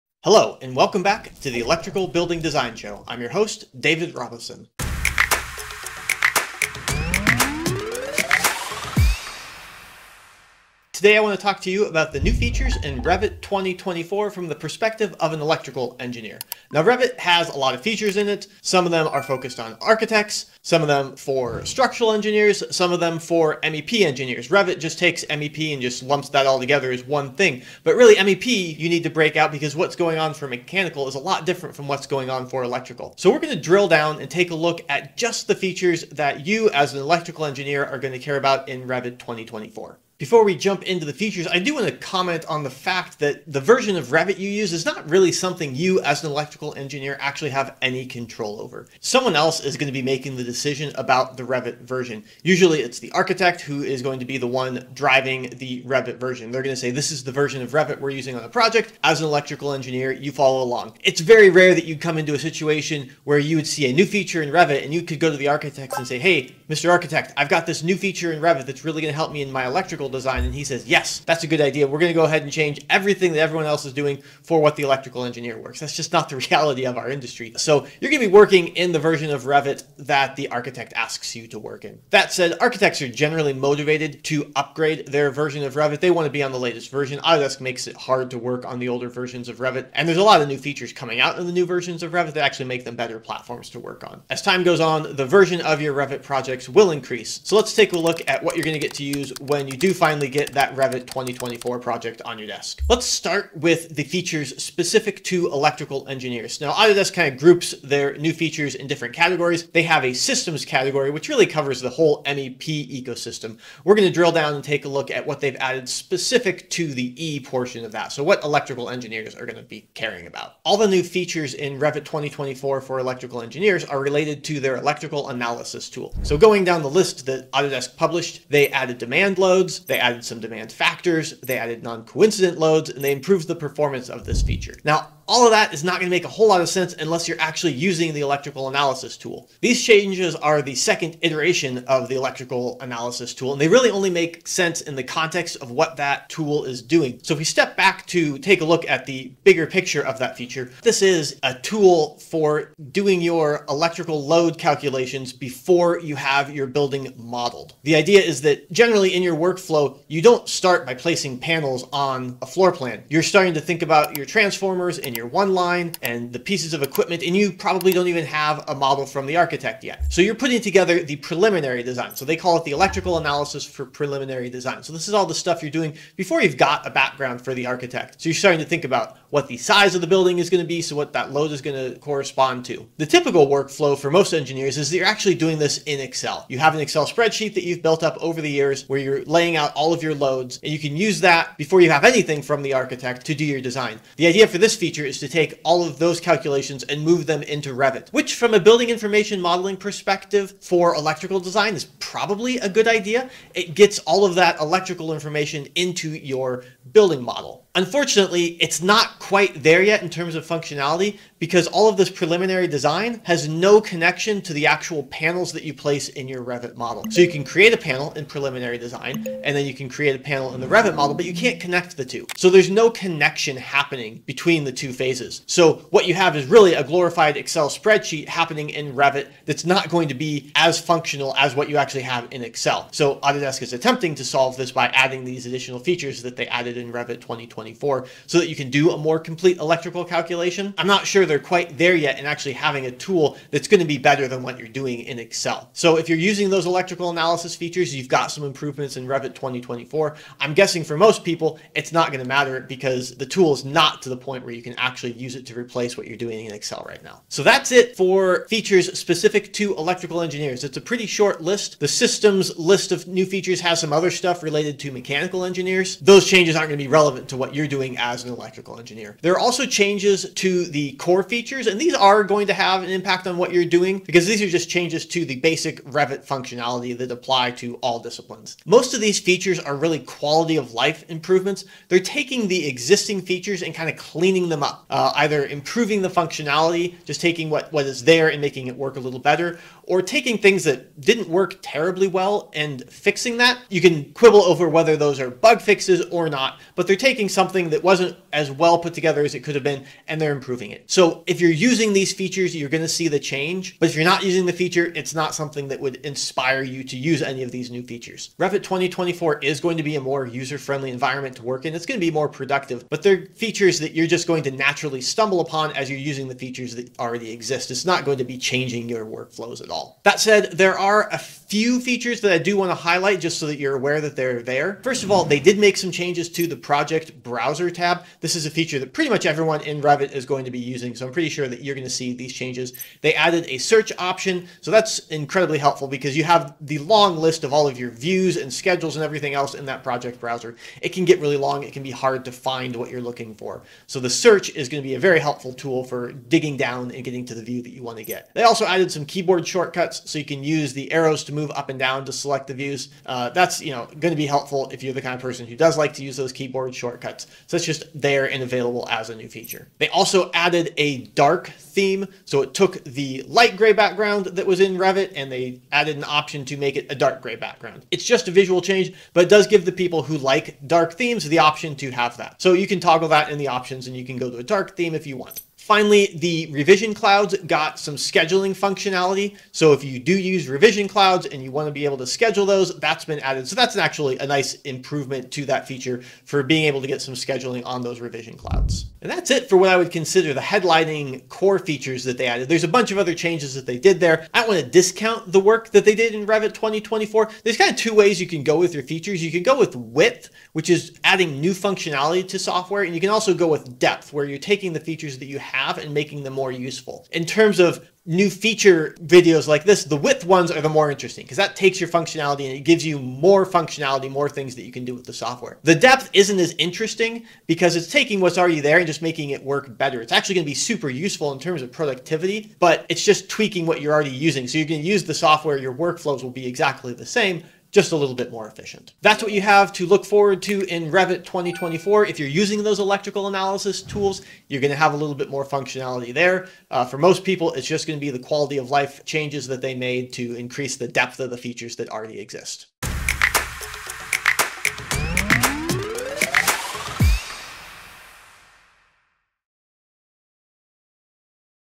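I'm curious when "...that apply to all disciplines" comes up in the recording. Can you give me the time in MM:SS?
04:36.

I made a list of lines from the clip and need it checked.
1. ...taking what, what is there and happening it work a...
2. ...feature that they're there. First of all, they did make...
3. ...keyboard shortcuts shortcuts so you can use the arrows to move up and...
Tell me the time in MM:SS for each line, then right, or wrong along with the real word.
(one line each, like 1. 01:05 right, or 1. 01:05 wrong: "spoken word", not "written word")
1. 04:47 wrong: "making", not "happening"
2. 05:23 wrong: "aware", not "feature"
3. 05:49 right.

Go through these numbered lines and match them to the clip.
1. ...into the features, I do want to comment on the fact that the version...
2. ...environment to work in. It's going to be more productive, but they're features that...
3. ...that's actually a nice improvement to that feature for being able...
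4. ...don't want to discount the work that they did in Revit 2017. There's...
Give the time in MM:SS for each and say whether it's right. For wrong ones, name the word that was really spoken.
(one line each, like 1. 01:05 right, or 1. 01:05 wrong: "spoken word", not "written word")
1. 00:40 right
2. 05:10 right
3. 06:23 right
4. 06:34 wrong: "2024", not "2017".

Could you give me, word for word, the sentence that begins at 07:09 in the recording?
That's what you have to look forward to in Revit 2024.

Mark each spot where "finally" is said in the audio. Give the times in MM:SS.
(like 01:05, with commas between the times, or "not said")
01:40, 06:15.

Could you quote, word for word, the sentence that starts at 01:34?
As time goes on, the version of your Revit projects will increase.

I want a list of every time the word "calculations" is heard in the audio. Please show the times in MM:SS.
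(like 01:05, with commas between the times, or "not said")
02:34, 03:16, 04:00.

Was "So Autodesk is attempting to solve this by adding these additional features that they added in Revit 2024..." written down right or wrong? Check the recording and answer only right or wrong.
right.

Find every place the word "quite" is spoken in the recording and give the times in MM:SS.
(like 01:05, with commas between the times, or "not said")
03:29, 04:01.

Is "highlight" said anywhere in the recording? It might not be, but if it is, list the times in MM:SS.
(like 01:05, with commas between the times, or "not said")
05:22.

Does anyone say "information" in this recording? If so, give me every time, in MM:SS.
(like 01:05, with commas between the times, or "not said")
03:18, 03:25.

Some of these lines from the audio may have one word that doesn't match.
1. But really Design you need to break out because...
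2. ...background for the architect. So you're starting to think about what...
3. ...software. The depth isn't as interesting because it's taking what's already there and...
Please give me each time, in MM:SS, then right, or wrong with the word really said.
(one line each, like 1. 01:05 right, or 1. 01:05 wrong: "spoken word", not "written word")
1. 00:27 wrong: "MEP", not "Design"
2. 02:56 right
3. 06:55 right.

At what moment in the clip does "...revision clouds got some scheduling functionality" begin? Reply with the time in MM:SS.
06:16.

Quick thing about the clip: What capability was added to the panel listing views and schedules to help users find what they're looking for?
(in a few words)
A search option.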